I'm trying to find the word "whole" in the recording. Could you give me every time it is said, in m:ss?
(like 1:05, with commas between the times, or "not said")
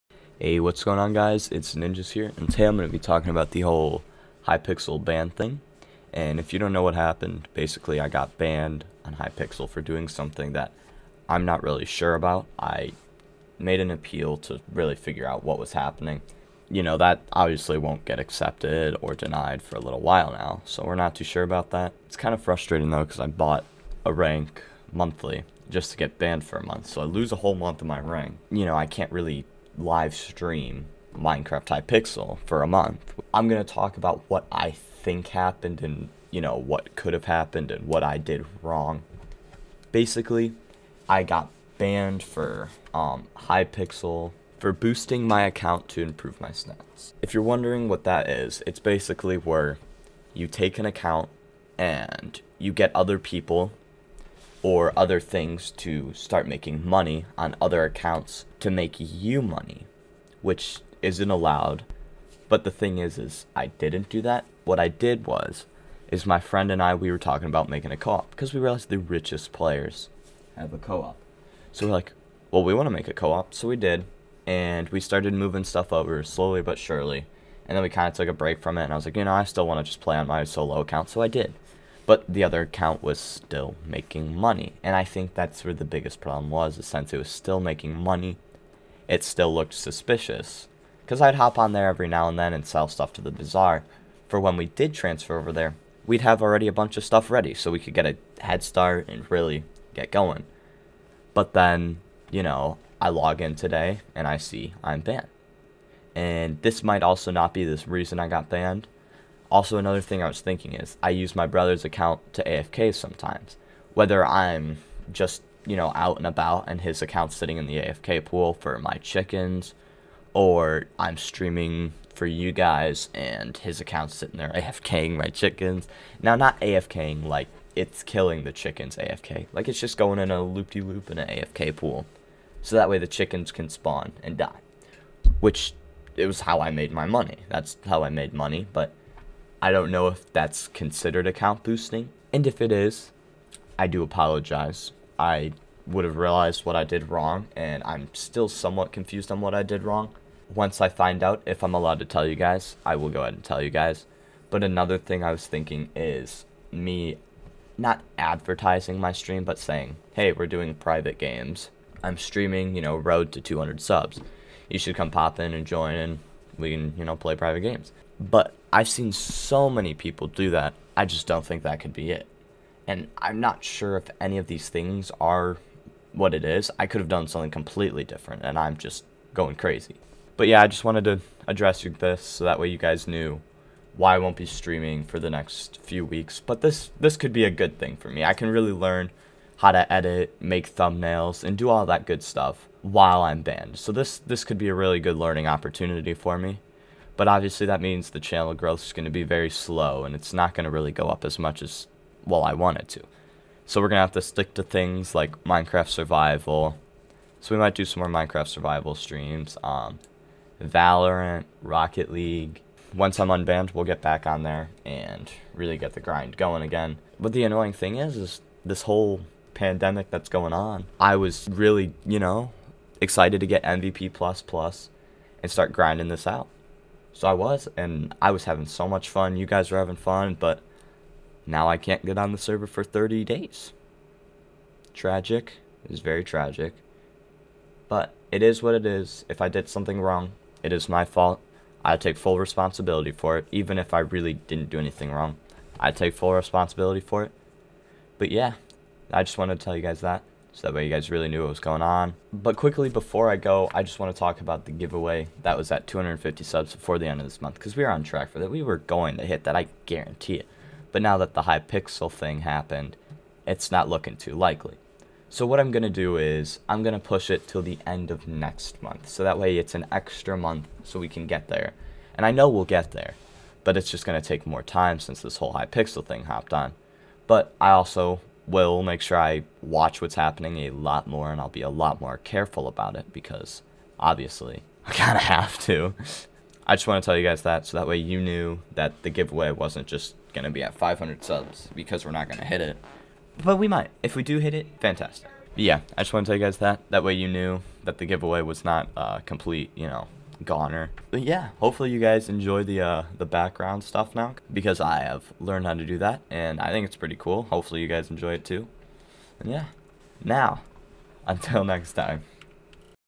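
0:03, 0:27, 3:38, 4:35.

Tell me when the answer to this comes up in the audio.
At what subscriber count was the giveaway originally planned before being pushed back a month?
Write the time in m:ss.
4:15.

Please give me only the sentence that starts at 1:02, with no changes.
But the thing is is I didn't do that.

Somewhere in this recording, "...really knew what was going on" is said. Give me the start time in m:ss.
4:11.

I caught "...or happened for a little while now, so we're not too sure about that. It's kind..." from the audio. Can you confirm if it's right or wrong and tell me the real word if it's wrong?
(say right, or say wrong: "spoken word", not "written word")
wrong: "denied", not "happened".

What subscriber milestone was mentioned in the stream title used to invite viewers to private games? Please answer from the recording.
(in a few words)
200.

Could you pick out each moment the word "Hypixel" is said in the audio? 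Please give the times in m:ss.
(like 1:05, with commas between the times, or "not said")
0:04, 0:09, 0:31, 0:43, 4:21, 4:35.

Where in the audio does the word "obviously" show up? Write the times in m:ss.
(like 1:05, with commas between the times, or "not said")
0:17, 3:17, 4:43.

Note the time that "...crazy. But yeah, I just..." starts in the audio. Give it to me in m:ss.
2:59.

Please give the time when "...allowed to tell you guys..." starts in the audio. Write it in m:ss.
2:31.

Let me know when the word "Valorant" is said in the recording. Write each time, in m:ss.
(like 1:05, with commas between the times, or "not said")
3:30.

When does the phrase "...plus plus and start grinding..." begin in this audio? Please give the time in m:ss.
3:44.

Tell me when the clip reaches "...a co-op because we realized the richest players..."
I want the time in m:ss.
1:07.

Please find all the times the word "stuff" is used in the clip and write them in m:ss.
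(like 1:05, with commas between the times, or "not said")
1:15, 1:32, 1:37, 3:12, 5:03.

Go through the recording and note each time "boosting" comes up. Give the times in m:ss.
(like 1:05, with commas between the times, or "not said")
0:44, 2:21.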